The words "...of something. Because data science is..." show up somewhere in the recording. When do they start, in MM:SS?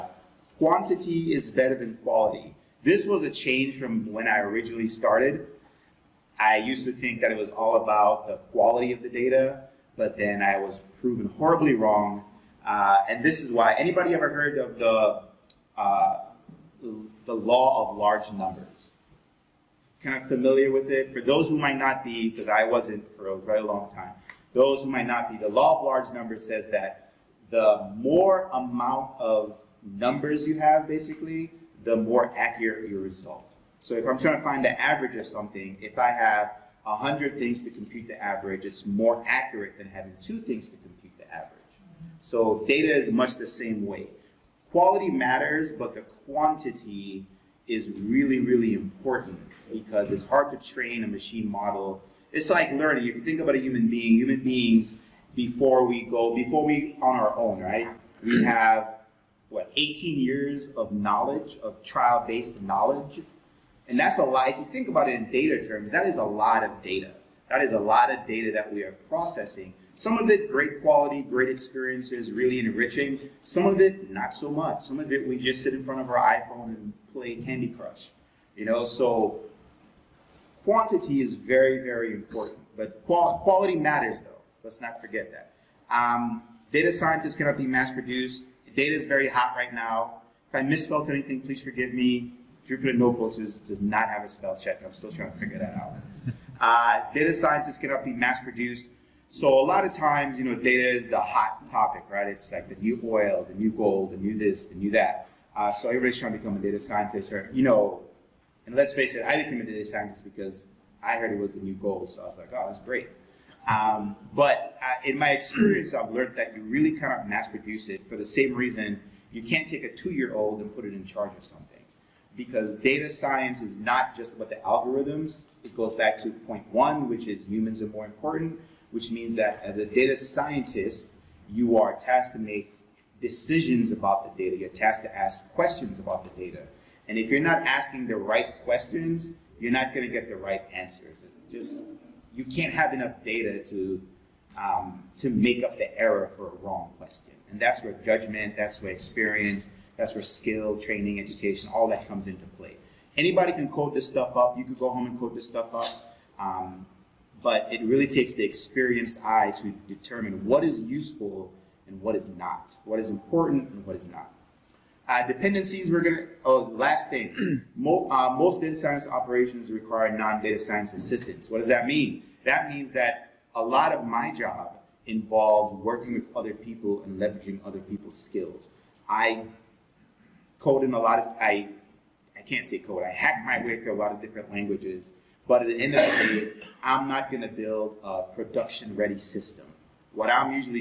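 02:01.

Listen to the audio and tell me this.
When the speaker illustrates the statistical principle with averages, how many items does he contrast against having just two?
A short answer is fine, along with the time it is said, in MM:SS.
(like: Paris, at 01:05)
100, at 00:36.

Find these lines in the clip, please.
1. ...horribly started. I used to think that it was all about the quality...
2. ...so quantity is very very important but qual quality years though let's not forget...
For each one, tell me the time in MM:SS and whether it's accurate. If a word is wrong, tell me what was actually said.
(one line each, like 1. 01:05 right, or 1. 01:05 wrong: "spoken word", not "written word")
1. 00:04 wrong: "originally", not "horribly"
2. 01:18 wrong: "matters", not "years".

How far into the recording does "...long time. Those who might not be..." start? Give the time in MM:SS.
00:23.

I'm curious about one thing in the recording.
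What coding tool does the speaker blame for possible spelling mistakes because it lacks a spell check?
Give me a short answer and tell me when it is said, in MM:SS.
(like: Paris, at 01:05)
Jupyter Notebooks, at 01:32.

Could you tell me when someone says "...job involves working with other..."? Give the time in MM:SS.
02:54.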